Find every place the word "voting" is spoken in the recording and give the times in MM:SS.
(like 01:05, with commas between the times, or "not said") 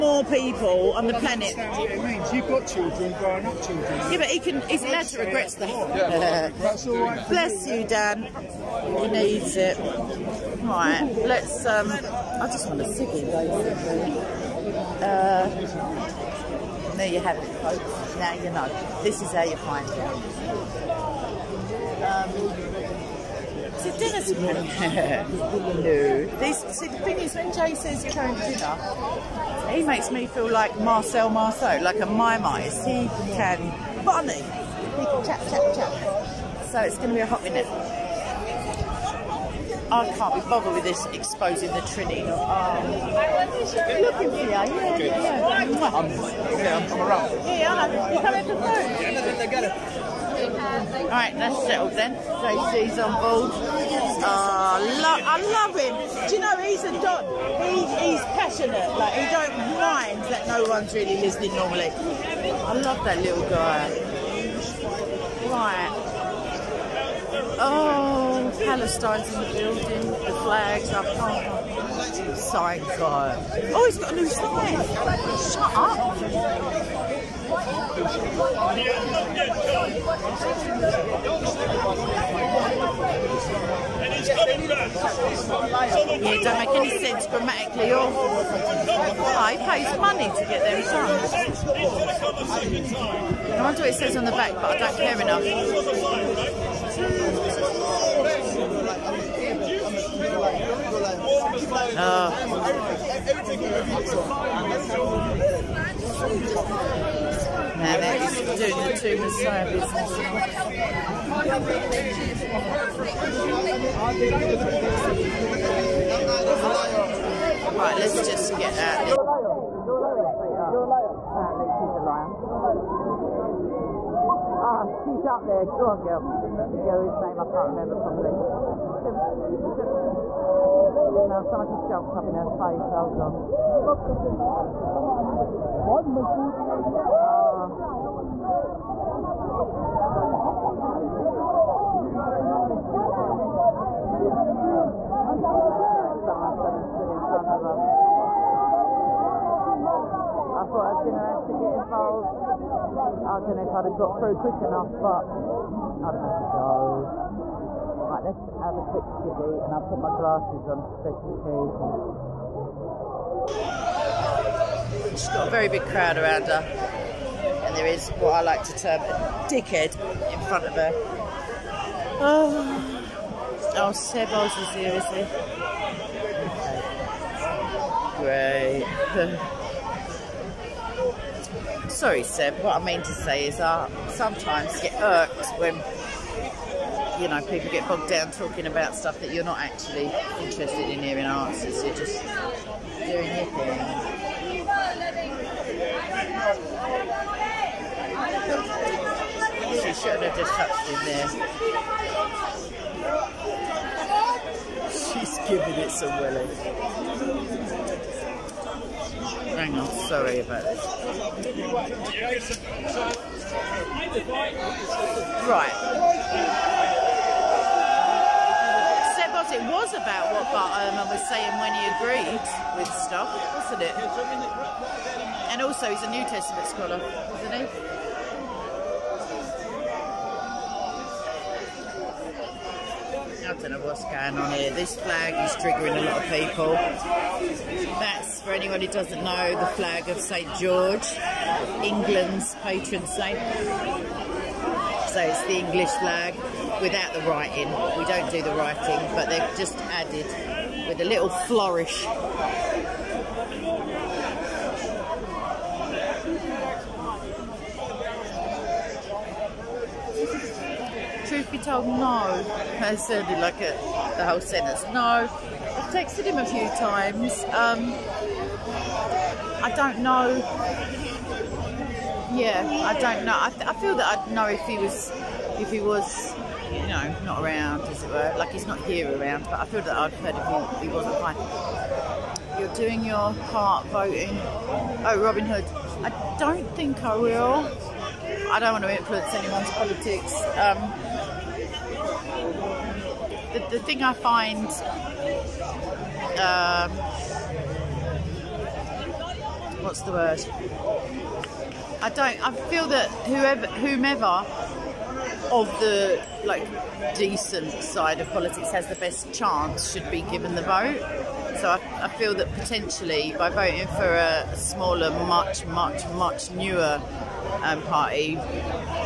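04:43, 05:13.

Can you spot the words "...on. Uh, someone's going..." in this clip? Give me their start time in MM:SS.
02:13.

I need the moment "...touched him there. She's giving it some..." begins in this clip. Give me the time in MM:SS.
03:20.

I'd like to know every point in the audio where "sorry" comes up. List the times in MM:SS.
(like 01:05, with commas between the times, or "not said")
01:12, 01:59, 03:01, 03:30.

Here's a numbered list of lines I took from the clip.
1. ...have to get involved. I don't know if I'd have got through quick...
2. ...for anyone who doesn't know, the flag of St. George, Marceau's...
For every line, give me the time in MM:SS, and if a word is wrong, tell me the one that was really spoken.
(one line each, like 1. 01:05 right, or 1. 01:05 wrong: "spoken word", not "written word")
1. 02:31 right
2. 03:58 wrong: "England", not "Marceau".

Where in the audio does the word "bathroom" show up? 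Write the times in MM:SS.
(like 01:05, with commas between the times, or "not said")
not said.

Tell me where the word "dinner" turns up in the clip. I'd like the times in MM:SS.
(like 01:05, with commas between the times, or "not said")
00:23, 00:28.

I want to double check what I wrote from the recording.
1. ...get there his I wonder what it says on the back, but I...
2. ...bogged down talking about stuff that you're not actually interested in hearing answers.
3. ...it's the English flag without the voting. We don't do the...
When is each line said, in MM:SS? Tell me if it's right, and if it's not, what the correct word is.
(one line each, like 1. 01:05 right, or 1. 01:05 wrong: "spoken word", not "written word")
1. 01:30 right
2. 03:07 right
3. 04:05 wrong: "writing", not "voting".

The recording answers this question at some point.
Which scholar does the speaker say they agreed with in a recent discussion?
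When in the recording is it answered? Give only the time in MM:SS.
03:40.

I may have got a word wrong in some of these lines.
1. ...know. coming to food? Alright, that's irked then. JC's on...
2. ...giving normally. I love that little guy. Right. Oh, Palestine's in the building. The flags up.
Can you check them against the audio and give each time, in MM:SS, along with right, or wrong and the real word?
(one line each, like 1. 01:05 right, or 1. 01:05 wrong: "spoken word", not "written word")
1. 00:47 wrong: "settled", not "irked"
2. 01:01 wrong: "listening", not "giving".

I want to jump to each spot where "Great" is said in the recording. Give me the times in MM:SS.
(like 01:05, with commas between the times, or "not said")
03:01.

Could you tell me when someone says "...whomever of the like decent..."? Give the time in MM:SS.
05:03.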